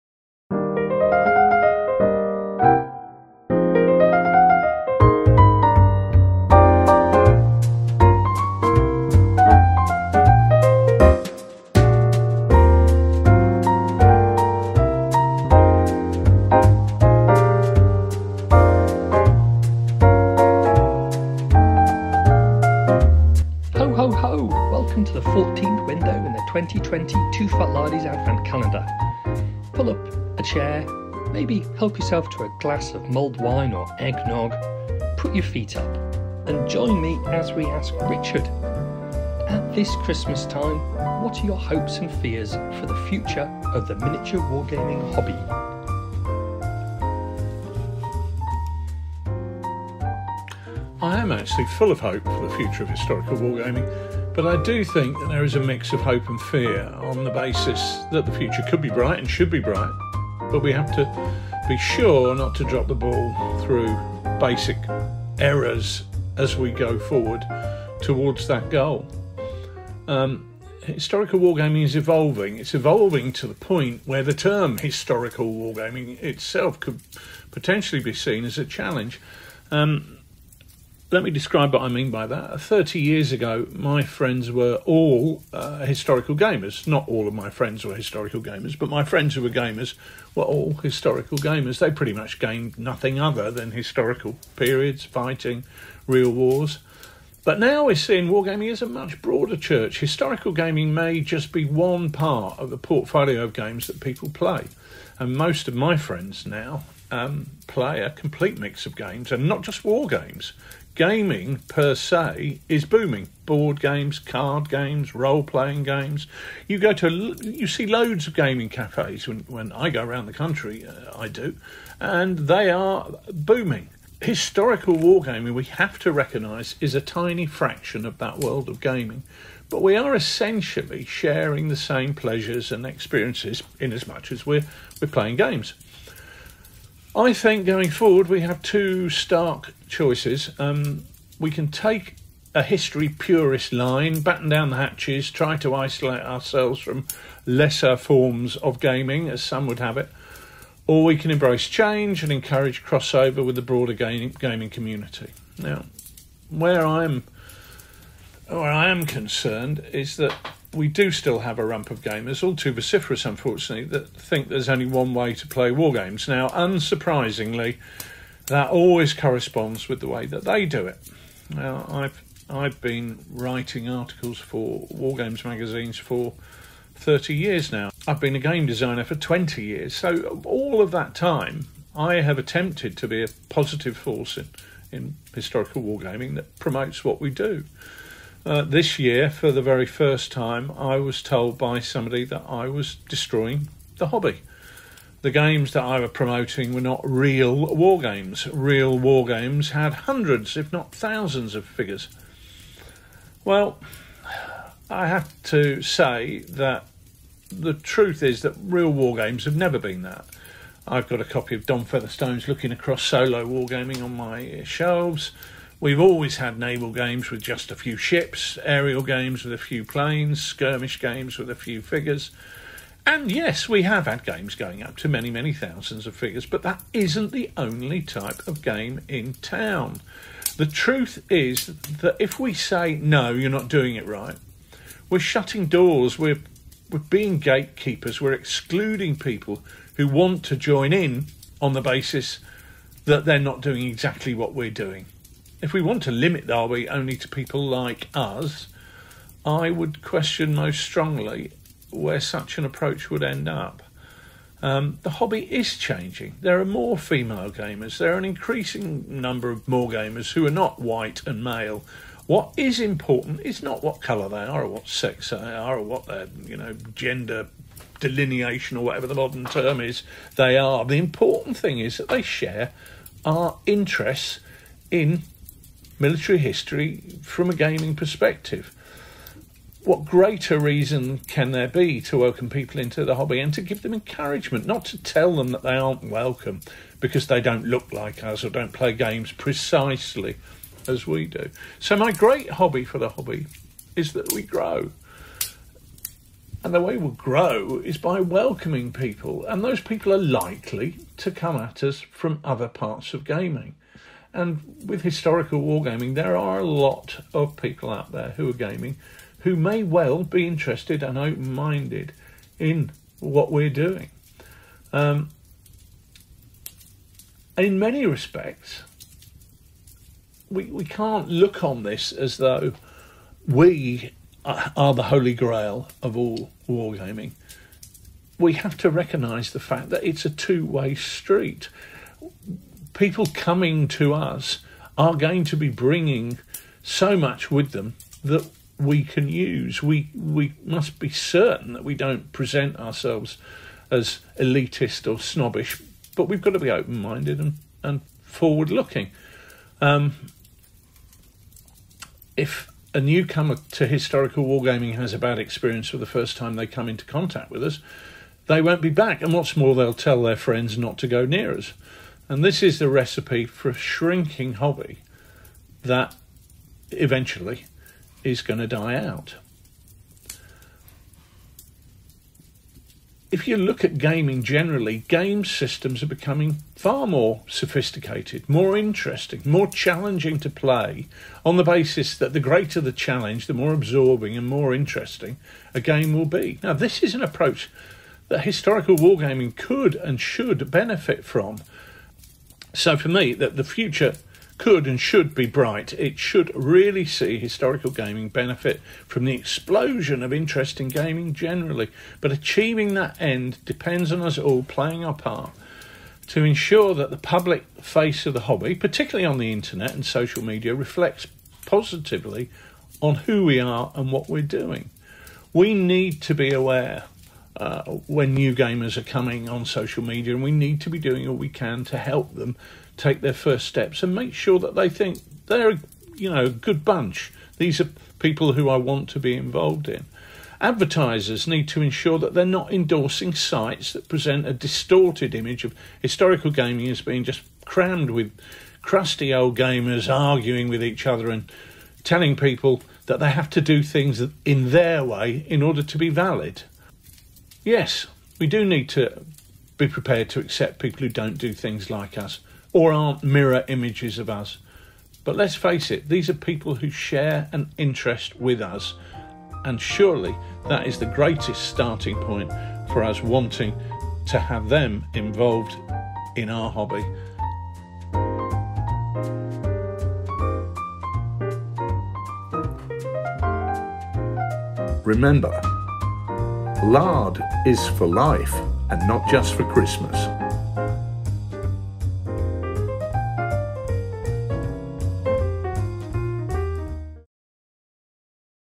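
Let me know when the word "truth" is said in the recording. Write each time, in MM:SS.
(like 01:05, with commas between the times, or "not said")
03:27, 03:50.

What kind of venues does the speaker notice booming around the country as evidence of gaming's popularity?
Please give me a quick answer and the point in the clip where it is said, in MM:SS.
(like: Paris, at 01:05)
gaming cafes, at 01:58.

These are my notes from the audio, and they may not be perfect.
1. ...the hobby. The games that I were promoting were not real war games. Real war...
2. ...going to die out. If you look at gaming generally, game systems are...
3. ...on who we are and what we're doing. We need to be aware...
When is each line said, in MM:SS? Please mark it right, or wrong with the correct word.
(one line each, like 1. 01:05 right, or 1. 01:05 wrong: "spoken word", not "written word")
1. 03:13 right
2. 06:08 right
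3. 06:53 right.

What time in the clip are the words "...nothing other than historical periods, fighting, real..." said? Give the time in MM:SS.
01:32.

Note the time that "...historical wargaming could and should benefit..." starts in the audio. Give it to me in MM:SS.
06:28.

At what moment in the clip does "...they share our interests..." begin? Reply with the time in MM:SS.
04:32.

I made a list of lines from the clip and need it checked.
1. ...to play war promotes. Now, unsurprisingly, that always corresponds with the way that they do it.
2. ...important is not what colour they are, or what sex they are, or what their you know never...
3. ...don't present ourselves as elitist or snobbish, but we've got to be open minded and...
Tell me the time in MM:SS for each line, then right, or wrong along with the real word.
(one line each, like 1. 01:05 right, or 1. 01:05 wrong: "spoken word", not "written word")
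1. 02:45 wrong: "games", not "promotes"
2. 04:22 wrong: "gender", not "never"
3. 05:41 right.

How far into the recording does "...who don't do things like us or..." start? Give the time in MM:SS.
07:31.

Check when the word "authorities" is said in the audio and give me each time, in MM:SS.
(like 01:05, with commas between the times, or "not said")
not said.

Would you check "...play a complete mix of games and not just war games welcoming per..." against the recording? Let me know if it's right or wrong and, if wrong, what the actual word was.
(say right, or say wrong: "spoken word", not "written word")
wrong: "gaming", not "welcoming".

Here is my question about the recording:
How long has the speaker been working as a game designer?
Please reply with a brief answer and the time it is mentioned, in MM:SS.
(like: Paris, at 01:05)
20 years, at 02:59.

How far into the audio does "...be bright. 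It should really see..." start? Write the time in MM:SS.
06:35.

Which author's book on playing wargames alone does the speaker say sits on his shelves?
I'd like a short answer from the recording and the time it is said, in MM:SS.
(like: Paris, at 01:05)
Don Featherstone, at 03:31.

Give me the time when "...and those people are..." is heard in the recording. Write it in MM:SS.
04:59.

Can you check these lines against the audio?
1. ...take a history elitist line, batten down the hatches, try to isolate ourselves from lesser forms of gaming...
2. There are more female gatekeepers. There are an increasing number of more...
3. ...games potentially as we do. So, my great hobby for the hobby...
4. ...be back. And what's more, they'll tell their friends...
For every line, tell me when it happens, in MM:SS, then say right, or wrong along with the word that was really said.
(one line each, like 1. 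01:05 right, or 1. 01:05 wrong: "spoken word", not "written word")
1. 02:21 wrong: "purist", not "elitist"
2. 04:16 wrong: "gamers", not "gatekeepers"
3. 04:48 wrong: "precisely", not "potentially"
4. 05:58 right.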